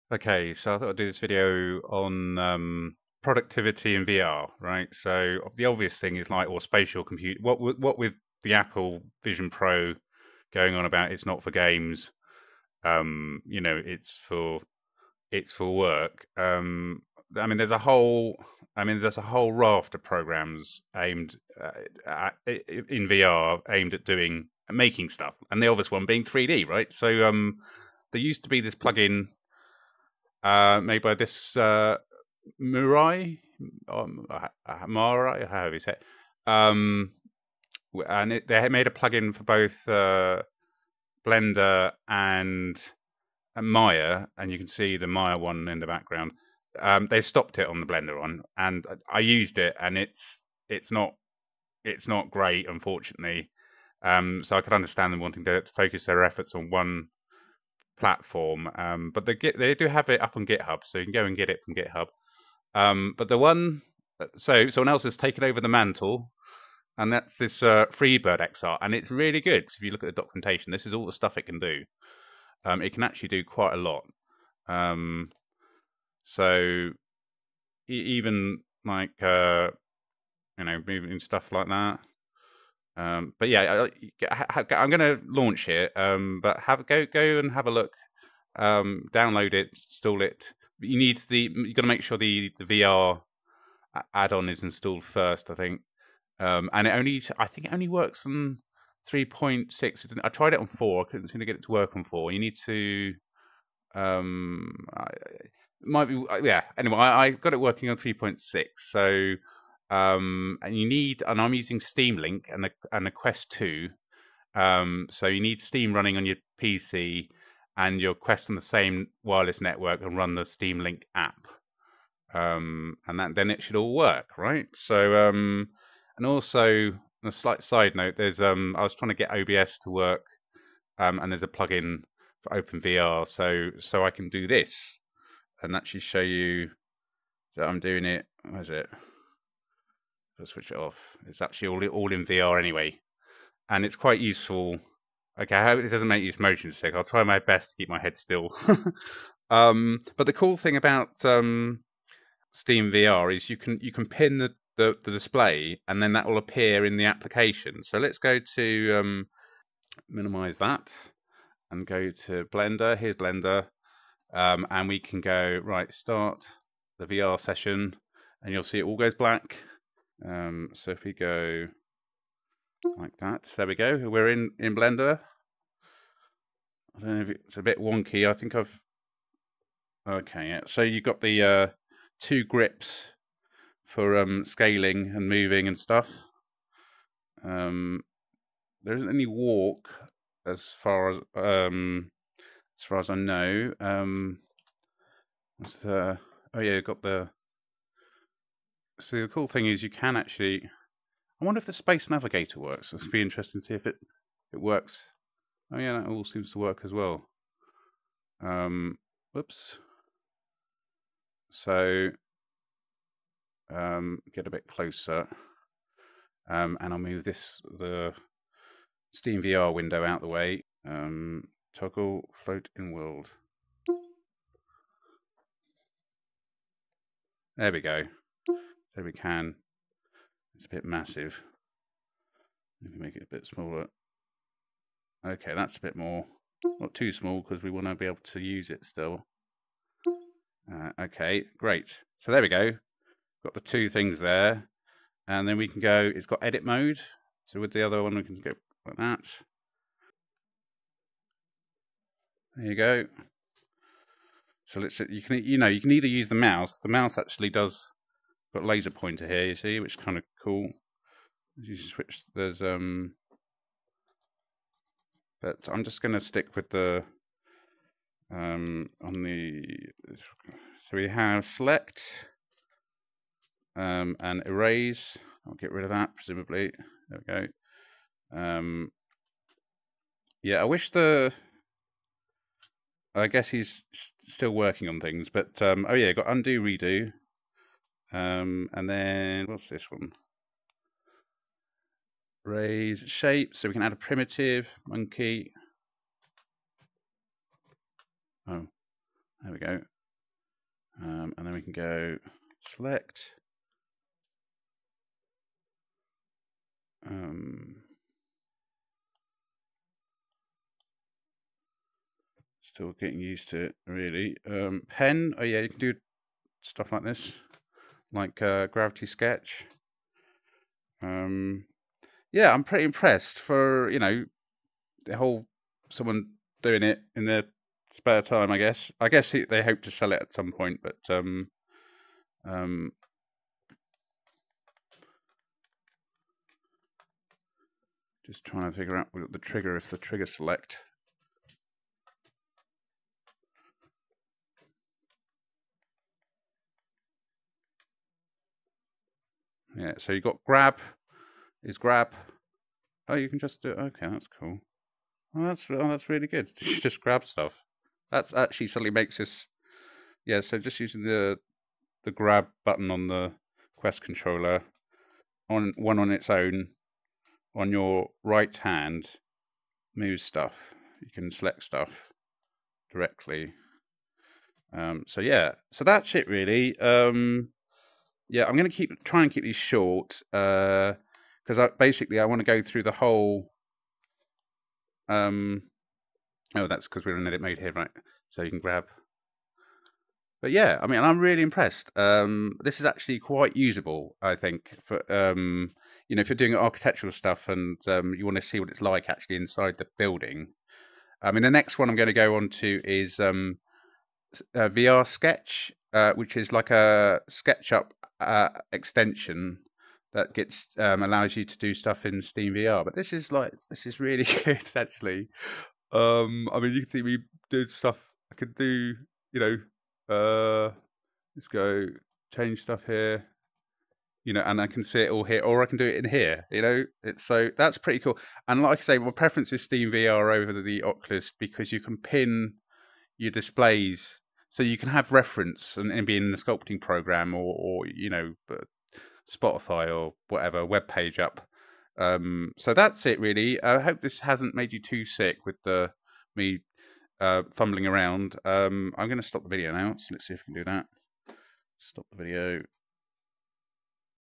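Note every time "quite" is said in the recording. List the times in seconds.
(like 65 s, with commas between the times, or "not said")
73 s, 143 s, 393 s.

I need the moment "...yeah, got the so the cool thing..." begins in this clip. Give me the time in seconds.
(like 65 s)
196 s.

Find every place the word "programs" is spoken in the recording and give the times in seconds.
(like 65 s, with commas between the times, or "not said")
20 s, 436 s.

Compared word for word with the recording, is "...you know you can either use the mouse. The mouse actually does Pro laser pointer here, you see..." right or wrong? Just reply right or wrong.
wrong.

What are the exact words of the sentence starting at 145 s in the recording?
Okay, I hope it doesn't make you motion sick.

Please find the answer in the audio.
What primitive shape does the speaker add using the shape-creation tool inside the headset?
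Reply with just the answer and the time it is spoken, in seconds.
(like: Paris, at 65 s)
Monkey, at 294 s.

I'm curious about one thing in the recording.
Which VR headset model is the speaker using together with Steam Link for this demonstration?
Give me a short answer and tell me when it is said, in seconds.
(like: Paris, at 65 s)
Quest Two, at 113 s.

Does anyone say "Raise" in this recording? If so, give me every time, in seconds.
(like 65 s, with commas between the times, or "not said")
292 s.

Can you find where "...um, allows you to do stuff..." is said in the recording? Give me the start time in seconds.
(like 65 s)
410 s.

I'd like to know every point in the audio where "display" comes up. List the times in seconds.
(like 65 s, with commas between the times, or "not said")
155 s, 433 s.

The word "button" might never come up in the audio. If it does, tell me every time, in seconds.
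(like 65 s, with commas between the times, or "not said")
362 s.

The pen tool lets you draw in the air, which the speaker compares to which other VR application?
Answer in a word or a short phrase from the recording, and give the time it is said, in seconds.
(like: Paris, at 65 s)
Gravity Sketch, at 318 s.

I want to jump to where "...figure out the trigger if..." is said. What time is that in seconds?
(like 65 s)
338 s.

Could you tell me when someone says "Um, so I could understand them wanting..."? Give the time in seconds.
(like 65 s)
54 s.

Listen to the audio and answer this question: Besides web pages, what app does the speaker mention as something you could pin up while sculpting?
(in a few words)
Spotify.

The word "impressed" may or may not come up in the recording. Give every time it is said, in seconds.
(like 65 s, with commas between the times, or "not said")
322 s, 391 s.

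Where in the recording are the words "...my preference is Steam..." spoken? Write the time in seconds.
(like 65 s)
428 s.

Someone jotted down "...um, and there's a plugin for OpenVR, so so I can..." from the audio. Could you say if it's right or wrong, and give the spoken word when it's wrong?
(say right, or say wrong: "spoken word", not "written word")
right.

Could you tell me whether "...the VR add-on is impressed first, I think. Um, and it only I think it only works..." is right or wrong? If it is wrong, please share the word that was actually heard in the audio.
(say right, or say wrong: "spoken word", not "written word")
wrong: "installed", not "impressed".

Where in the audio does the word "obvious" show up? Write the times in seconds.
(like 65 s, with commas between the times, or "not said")
5 s, 25 s.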